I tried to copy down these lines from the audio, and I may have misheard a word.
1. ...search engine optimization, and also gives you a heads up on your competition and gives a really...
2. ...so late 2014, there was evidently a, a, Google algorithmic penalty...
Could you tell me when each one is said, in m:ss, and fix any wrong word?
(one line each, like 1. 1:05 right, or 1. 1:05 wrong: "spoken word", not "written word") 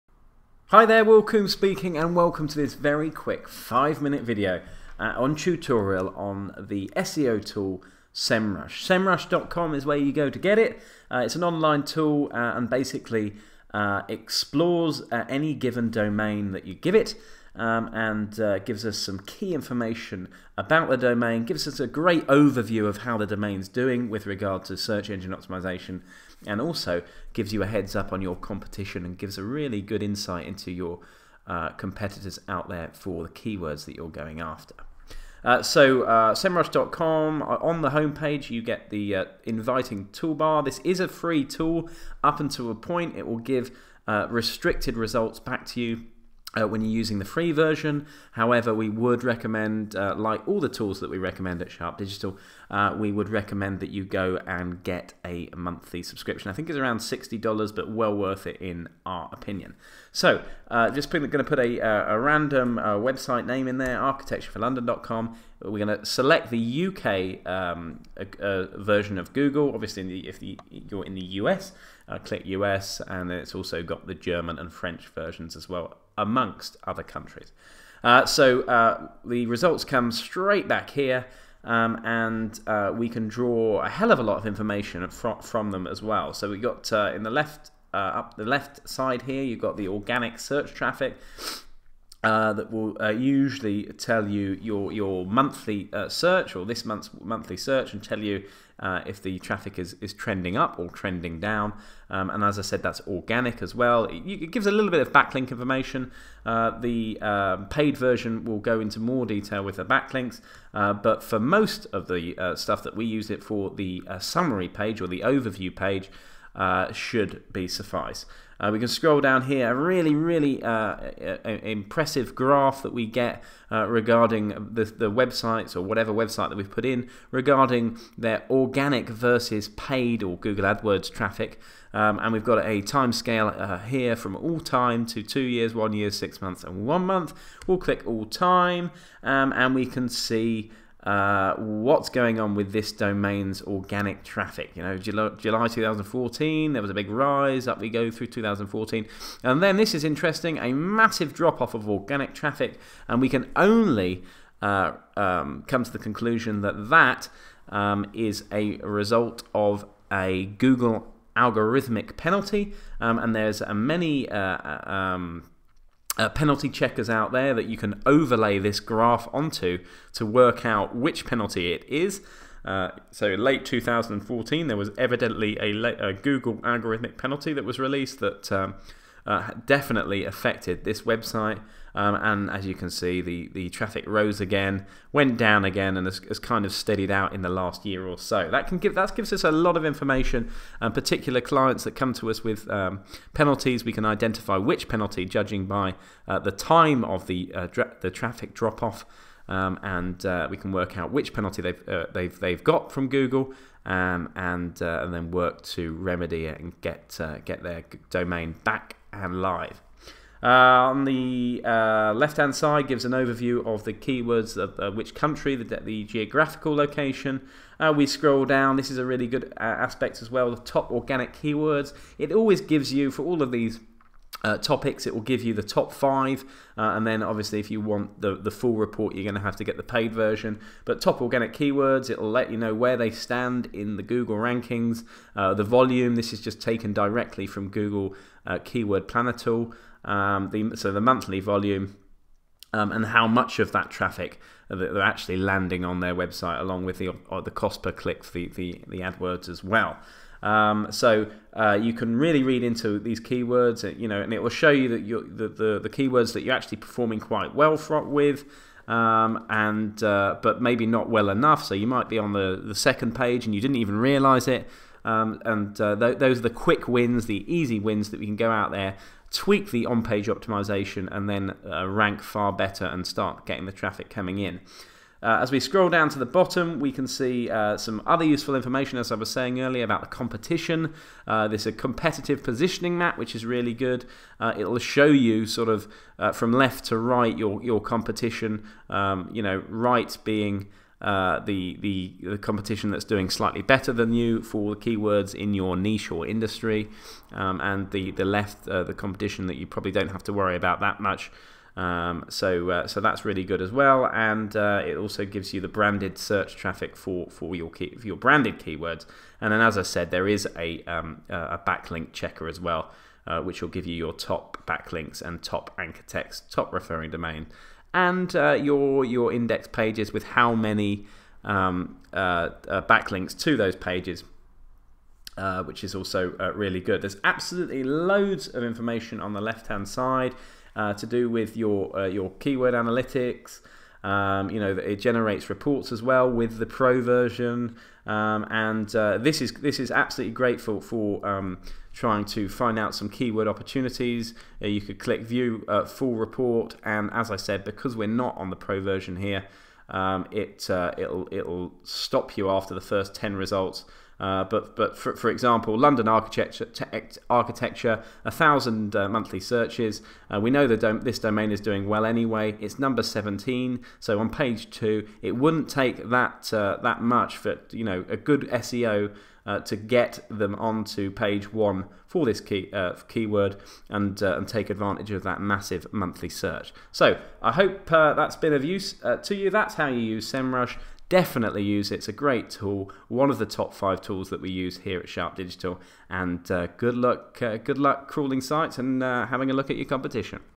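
1. 0:24 right
2. 2:53 right.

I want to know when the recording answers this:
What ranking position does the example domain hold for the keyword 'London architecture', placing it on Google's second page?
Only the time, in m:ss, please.
6:03.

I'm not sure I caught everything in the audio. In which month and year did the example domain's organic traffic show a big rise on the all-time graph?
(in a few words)
July 2014.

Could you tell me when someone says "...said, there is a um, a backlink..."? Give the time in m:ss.
5:09.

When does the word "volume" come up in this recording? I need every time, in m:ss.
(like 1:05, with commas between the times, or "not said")
3:55, 4:01.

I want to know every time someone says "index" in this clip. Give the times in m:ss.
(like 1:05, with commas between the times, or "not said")
5:19.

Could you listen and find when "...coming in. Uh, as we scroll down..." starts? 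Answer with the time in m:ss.
4:34.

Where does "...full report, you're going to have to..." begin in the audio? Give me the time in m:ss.
3:48.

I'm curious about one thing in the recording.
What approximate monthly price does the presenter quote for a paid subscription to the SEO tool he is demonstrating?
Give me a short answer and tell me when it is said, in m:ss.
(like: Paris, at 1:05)
$60, at 0:56.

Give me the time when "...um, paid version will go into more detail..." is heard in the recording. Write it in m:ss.
1:47.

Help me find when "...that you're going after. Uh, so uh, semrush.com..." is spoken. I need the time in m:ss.
0:33.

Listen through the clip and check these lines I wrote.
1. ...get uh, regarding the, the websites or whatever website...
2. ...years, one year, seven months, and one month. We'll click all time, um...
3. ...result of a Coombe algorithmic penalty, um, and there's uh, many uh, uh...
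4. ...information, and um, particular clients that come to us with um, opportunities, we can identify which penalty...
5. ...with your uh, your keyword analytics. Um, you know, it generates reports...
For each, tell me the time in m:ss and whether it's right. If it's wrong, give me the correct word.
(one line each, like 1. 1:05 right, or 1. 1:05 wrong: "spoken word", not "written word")
1. 2:03 right
2. 2:15 wrong: "six", not "seven"
3. 2:38 wrong: "Google", not "Coombe"
4. 3:09 wrong: "penalties", not "opportunities"
5. 5:31 right.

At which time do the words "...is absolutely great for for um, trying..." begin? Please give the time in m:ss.
5:39.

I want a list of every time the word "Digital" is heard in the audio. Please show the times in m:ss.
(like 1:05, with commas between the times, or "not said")
0:51, 6:25.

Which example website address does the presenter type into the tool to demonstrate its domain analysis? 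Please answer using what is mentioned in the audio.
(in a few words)
architectureforlondon.com.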